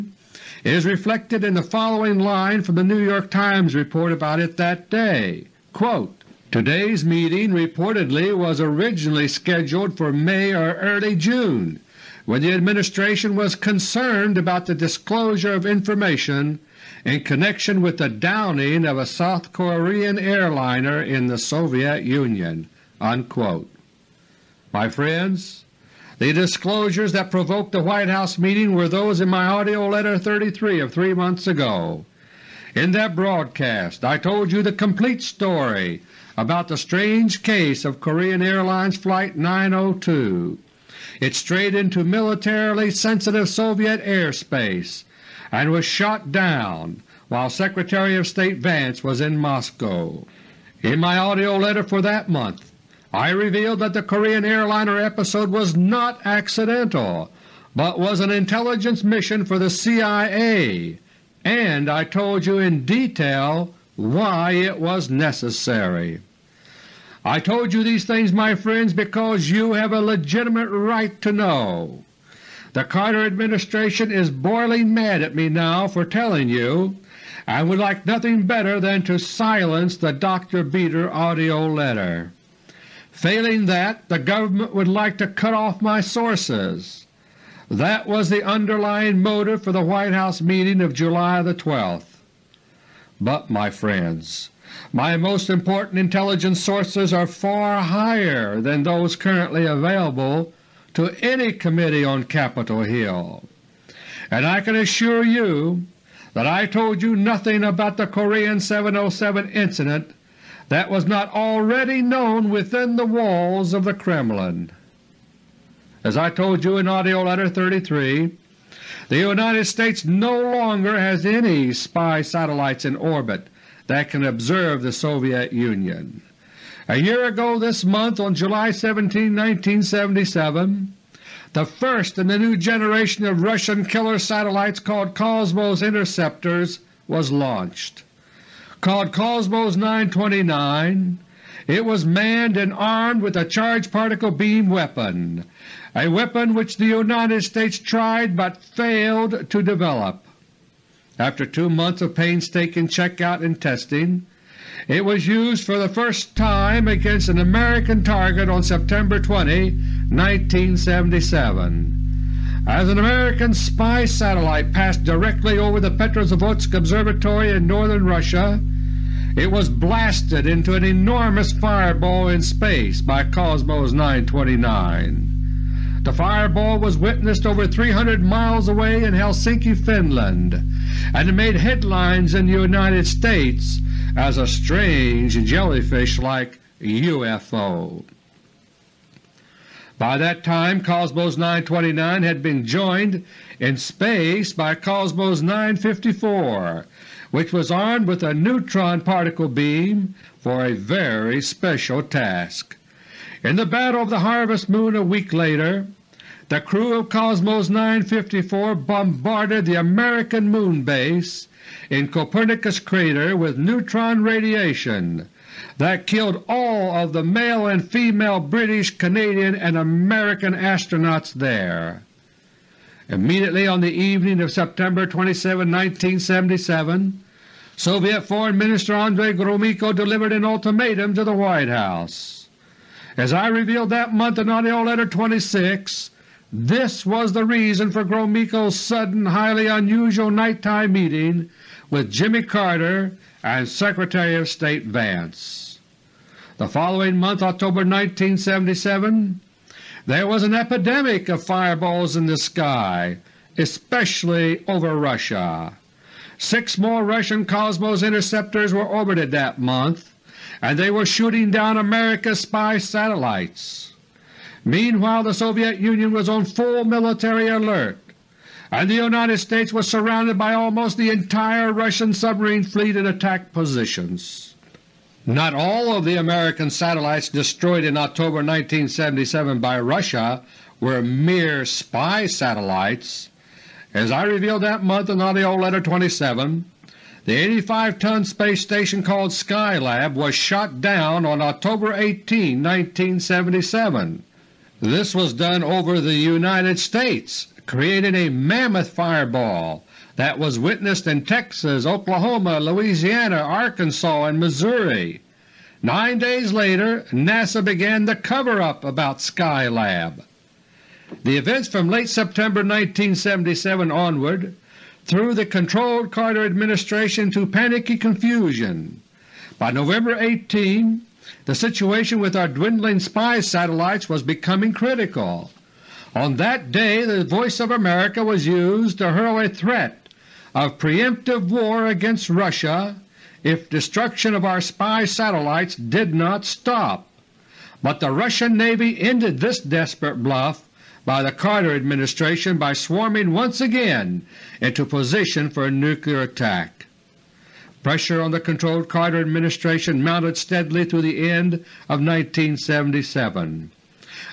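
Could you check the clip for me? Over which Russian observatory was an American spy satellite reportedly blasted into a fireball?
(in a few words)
Petrozavodsk Observatory.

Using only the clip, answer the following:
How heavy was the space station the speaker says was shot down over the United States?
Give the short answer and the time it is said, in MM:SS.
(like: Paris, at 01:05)
85 tons, at 04:47.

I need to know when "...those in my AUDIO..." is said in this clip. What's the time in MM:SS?
00:28.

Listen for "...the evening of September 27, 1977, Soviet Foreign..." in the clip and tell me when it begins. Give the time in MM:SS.
03:43.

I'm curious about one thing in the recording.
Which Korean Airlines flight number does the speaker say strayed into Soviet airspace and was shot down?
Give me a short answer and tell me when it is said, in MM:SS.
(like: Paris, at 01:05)
902, at 00:38.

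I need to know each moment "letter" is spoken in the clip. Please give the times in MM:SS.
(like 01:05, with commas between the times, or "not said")
00:29, 00:51, 01:21, 01:57, 03:54, 04:45.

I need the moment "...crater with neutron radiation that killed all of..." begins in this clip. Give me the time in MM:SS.
03:32.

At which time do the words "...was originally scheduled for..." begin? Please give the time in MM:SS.
00:08.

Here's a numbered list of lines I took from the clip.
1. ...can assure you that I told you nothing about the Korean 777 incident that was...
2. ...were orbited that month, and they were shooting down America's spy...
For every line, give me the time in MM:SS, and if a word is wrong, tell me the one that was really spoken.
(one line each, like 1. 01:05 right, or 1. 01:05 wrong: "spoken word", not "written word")
1. 01:44 wrong: "707", not "777"
2. 04:18 right.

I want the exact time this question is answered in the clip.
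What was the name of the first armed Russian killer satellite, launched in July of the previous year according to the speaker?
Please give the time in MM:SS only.
02:18.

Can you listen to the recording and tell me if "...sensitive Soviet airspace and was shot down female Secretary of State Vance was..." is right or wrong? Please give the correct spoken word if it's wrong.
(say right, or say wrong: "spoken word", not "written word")
wrong: "while", not "female".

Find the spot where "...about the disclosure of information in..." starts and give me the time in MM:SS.
00:14.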